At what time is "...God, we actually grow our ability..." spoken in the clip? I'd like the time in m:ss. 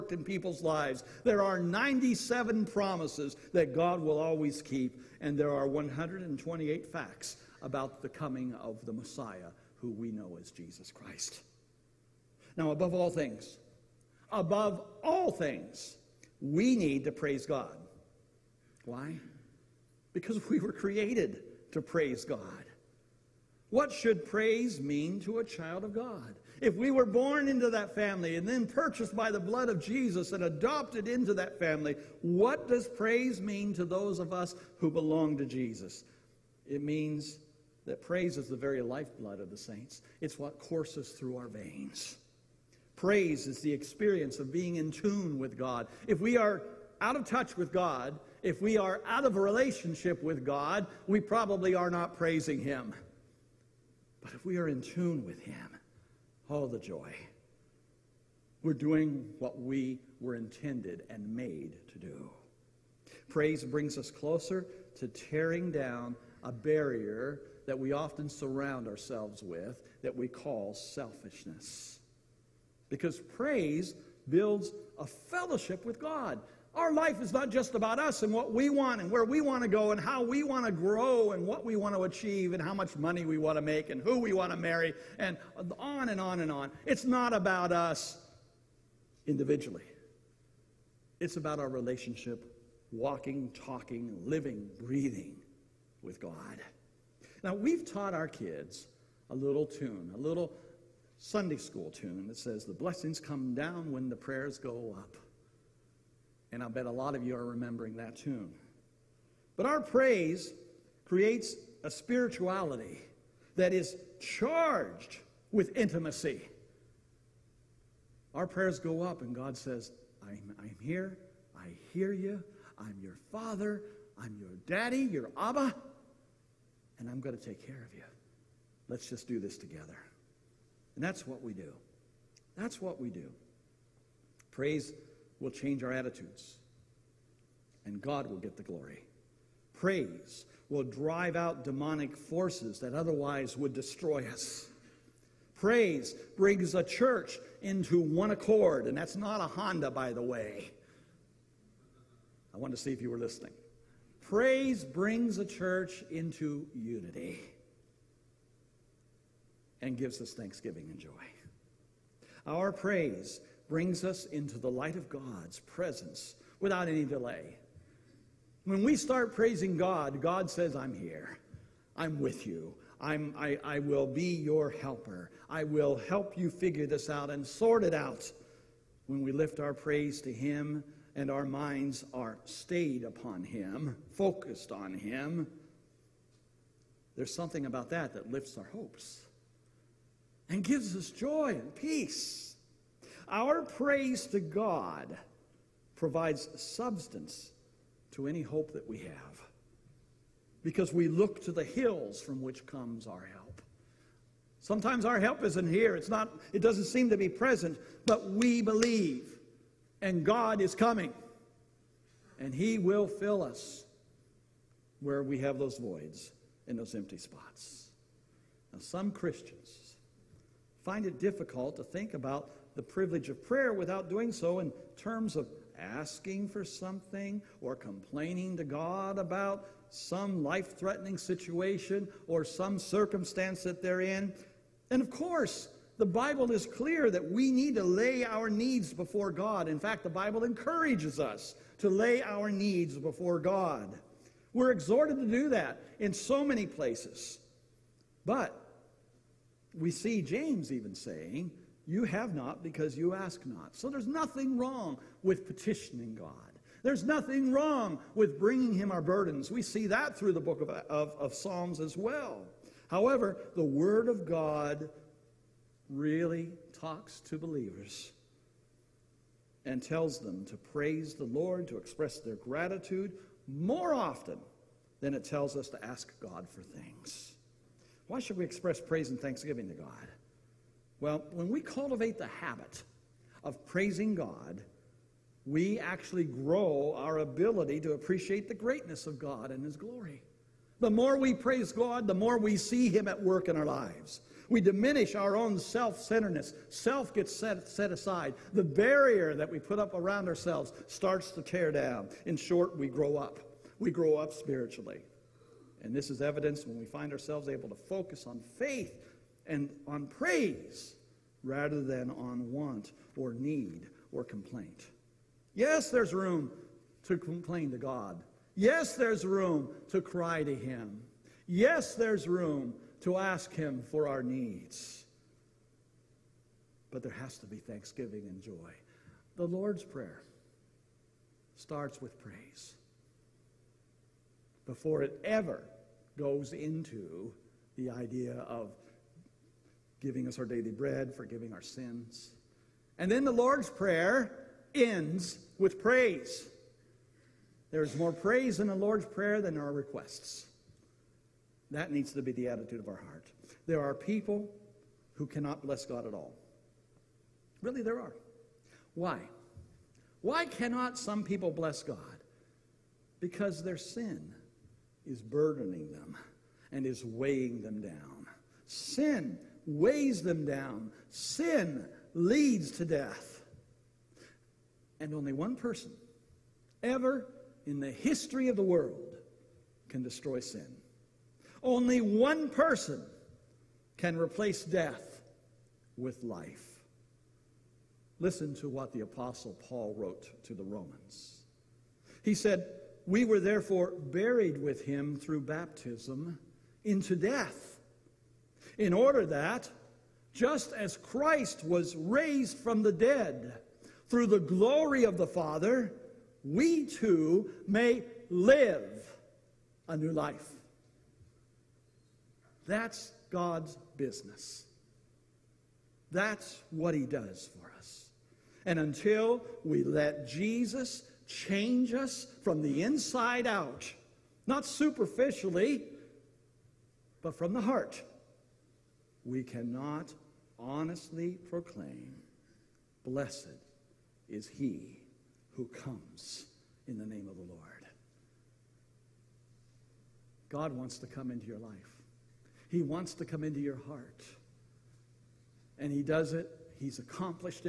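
4:44.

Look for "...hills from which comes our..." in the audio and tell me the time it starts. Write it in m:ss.
3:21.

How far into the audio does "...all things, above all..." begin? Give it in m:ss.
0:12.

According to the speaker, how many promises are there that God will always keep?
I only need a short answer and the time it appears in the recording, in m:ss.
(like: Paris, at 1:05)
97, at 0:01.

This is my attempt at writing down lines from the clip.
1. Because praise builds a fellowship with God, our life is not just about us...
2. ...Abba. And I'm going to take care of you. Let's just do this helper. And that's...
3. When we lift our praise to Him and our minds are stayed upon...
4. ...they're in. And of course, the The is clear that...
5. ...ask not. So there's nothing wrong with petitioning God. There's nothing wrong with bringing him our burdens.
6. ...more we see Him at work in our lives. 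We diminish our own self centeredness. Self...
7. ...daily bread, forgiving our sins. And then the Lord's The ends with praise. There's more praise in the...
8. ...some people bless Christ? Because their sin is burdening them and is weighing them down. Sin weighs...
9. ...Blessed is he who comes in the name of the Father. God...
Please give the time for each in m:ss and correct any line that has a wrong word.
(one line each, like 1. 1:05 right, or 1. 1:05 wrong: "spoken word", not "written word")
1. 1:12 right
2. 2:05 wrong: "together", not "helper"
3. 2:59 right
4. 3:53 wrong: "Bible", not "The"
5. 4:13 right
6. 4:52 right
7. 5:40 wrong: "Prayer", not "The"
8. 6:00 wrong: "God", not "Christ"
9. 7:13 wrong: "Lord", not "Father".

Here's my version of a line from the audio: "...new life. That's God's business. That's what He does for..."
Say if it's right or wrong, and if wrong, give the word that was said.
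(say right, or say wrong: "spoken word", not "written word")
right.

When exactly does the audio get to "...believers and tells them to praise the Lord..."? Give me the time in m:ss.
4:27.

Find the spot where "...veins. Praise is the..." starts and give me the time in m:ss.
0:41.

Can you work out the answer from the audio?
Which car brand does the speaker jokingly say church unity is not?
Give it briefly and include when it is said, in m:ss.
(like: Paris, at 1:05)
Honda, at 2:29.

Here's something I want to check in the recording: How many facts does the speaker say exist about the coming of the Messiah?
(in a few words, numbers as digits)
128.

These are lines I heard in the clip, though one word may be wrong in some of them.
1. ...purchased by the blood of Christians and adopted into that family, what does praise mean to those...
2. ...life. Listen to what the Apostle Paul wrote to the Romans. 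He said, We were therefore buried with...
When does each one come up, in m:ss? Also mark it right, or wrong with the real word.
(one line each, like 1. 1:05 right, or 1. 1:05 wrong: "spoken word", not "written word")
1. 0:28 wrong: "Jesus", not "Christians"
2. 6:26 right.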